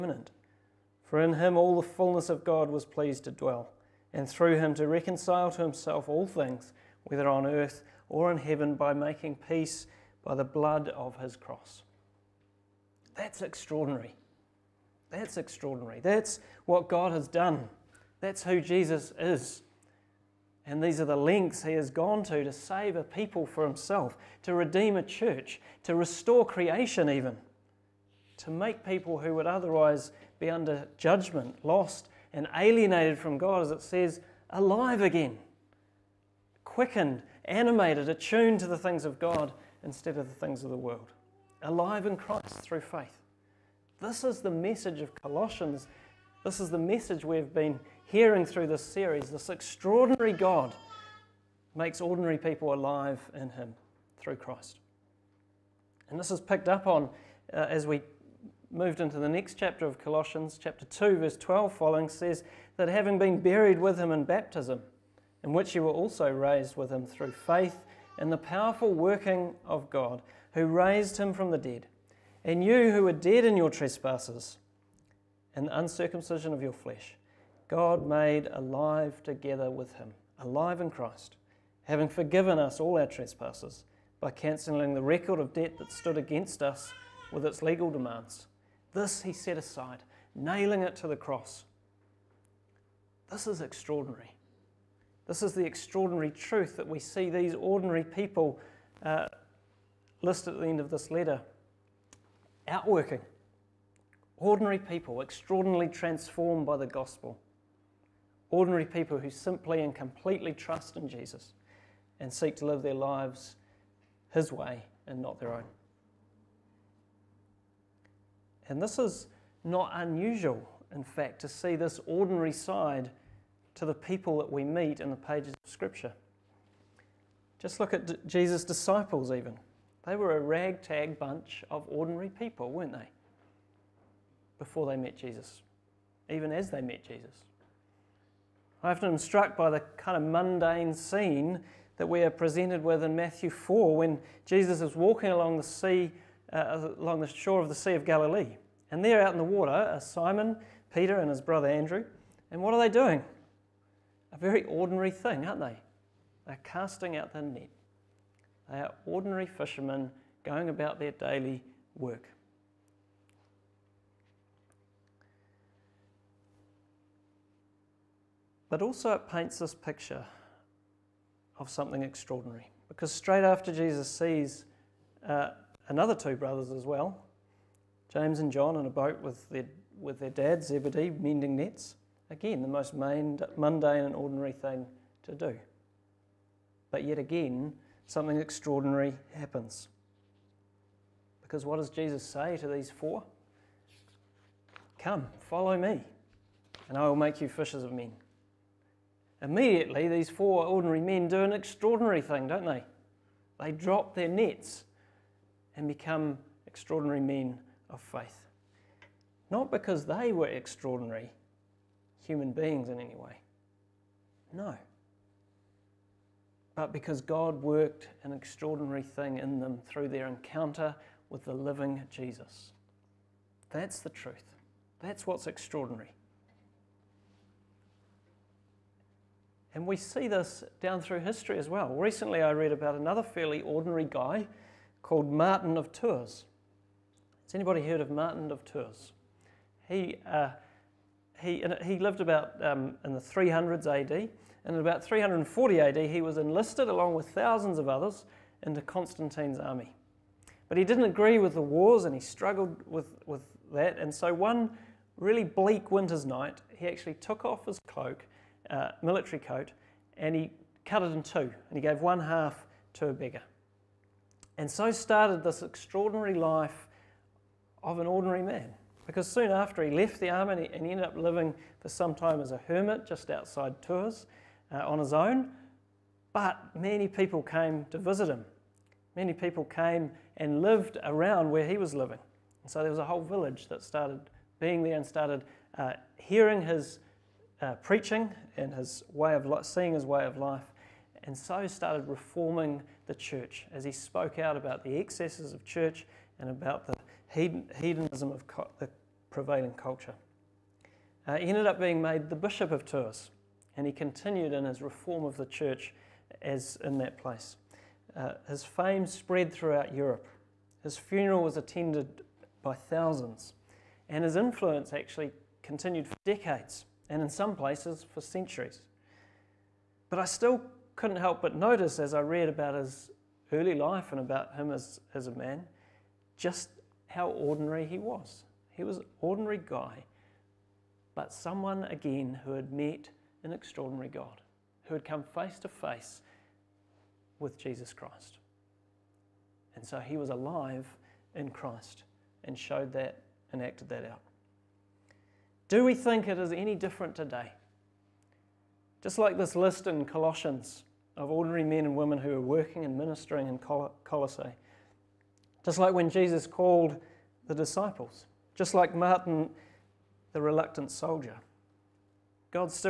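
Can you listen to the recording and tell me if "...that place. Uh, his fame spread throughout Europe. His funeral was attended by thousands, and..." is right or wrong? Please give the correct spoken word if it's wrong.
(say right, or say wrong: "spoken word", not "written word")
right.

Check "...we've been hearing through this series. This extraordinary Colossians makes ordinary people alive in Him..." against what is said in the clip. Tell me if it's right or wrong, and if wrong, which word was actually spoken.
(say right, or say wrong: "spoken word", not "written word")
wrong: "God", not "Colossians".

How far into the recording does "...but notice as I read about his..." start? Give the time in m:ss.
5:21.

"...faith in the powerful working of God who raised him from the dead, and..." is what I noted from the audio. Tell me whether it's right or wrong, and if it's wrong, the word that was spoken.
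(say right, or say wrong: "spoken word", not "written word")
right.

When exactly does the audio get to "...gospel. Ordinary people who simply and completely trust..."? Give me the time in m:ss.
1:46.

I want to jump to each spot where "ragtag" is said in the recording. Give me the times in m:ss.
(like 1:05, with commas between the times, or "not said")
2:10.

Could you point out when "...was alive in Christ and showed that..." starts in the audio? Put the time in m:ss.
5:40.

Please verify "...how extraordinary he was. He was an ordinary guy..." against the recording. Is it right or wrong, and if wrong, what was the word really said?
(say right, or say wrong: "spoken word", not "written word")
wrong: "ordinary", not "extraordinary".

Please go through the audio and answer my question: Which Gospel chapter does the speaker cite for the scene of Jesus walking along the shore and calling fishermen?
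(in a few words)
Matthew 4.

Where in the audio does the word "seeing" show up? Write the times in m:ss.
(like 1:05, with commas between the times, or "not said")
4:49.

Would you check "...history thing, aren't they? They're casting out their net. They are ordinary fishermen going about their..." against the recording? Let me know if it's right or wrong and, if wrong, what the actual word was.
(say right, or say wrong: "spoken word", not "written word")
wrong: "ordinary", not "history".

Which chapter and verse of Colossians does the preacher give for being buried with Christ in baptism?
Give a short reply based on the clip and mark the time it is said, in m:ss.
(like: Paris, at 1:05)
chapter 2, verse 12, at 1:00.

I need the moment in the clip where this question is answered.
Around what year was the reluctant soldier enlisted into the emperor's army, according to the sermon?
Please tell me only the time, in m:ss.
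4:05.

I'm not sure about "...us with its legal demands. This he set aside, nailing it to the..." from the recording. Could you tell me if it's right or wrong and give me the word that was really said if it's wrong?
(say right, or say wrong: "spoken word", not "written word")
right.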